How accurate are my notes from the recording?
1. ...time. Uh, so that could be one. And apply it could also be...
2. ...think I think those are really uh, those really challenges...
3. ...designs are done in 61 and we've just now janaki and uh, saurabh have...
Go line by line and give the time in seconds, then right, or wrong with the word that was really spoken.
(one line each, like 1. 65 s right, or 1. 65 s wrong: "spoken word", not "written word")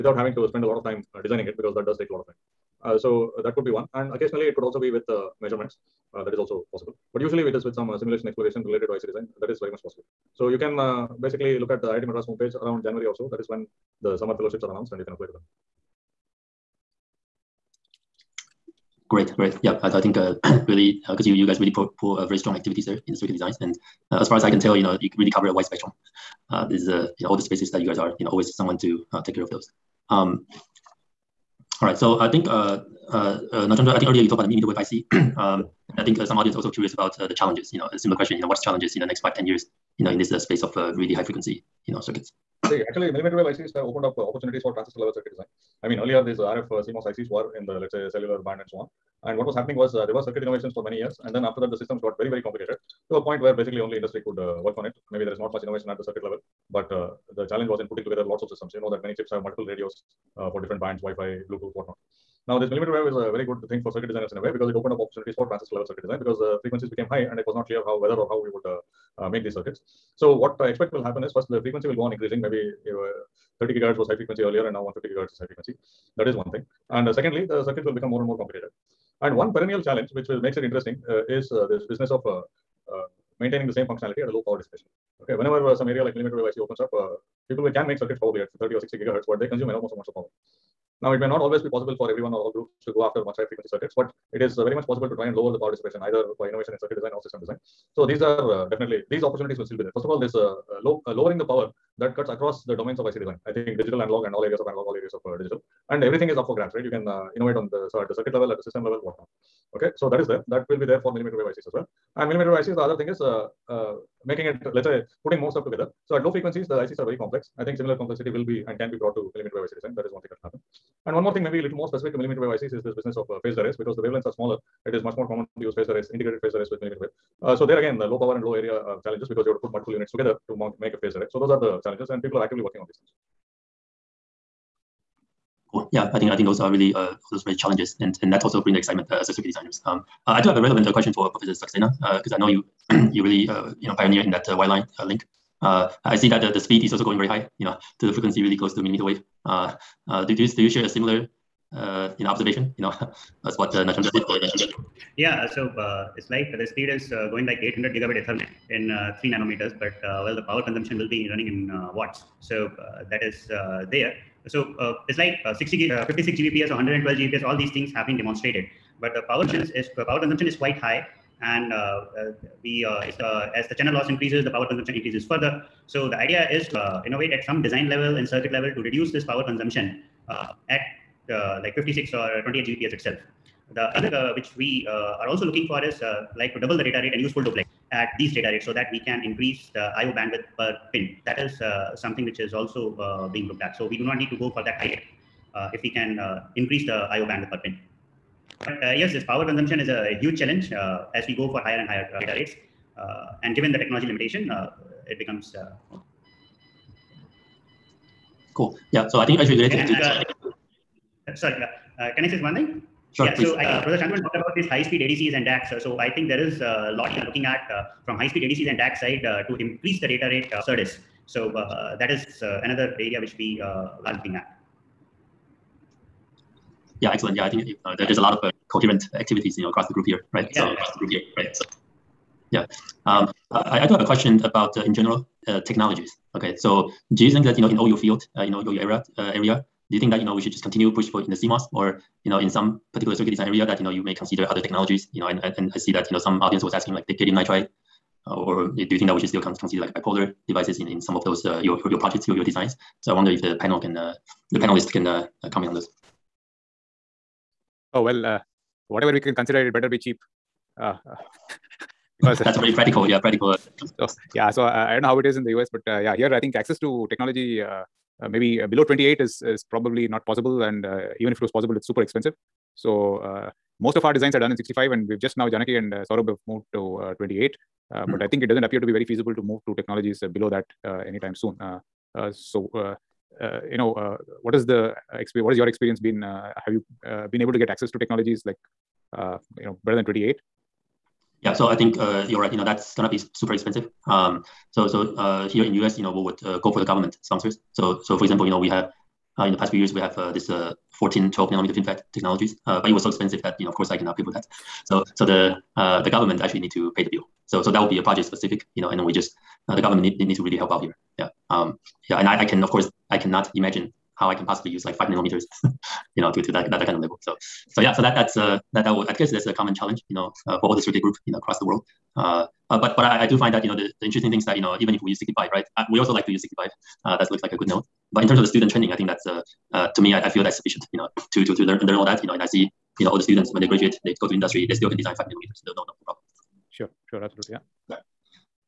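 1. 2 s wrong: "occasionally", not "apply"
2. 136 s right
3. 274 s wrong: "65", not "61".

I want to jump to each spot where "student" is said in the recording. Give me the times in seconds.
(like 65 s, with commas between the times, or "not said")
328 s, 333 s.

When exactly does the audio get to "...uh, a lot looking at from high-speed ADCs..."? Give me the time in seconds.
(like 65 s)
216 s.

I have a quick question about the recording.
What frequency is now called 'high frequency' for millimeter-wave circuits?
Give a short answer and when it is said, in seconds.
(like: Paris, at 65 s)
150 gigahertz, at 74 s.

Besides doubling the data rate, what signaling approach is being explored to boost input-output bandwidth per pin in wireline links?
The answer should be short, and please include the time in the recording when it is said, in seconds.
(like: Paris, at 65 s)
full duplex, at 187 s.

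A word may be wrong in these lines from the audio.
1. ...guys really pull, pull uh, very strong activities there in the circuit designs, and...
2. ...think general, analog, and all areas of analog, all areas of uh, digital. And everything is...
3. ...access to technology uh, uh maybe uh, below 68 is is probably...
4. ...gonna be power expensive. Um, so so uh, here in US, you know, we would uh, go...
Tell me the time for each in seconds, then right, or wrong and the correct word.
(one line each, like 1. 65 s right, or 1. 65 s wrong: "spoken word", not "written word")
1. 21 s right
2. 103 s wrong: "digital", not "general"
3. 266 s wrong: "28", not "68"
4. 292 s wrong: "super", not "power".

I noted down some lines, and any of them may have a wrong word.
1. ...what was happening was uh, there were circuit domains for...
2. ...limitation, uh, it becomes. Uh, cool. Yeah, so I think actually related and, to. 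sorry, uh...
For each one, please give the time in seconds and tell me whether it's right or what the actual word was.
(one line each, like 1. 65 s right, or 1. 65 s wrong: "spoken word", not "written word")
1. 49 s wrong: "innovations", not "domains"
2. 204 s right.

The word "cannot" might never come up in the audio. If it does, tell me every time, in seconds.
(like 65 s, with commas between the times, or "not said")
303 s, 313 s.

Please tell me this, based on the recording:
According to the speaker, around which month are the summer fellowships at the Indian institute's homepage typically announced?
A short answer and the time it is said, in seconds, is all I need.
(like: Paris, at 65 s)
January, at 12 s.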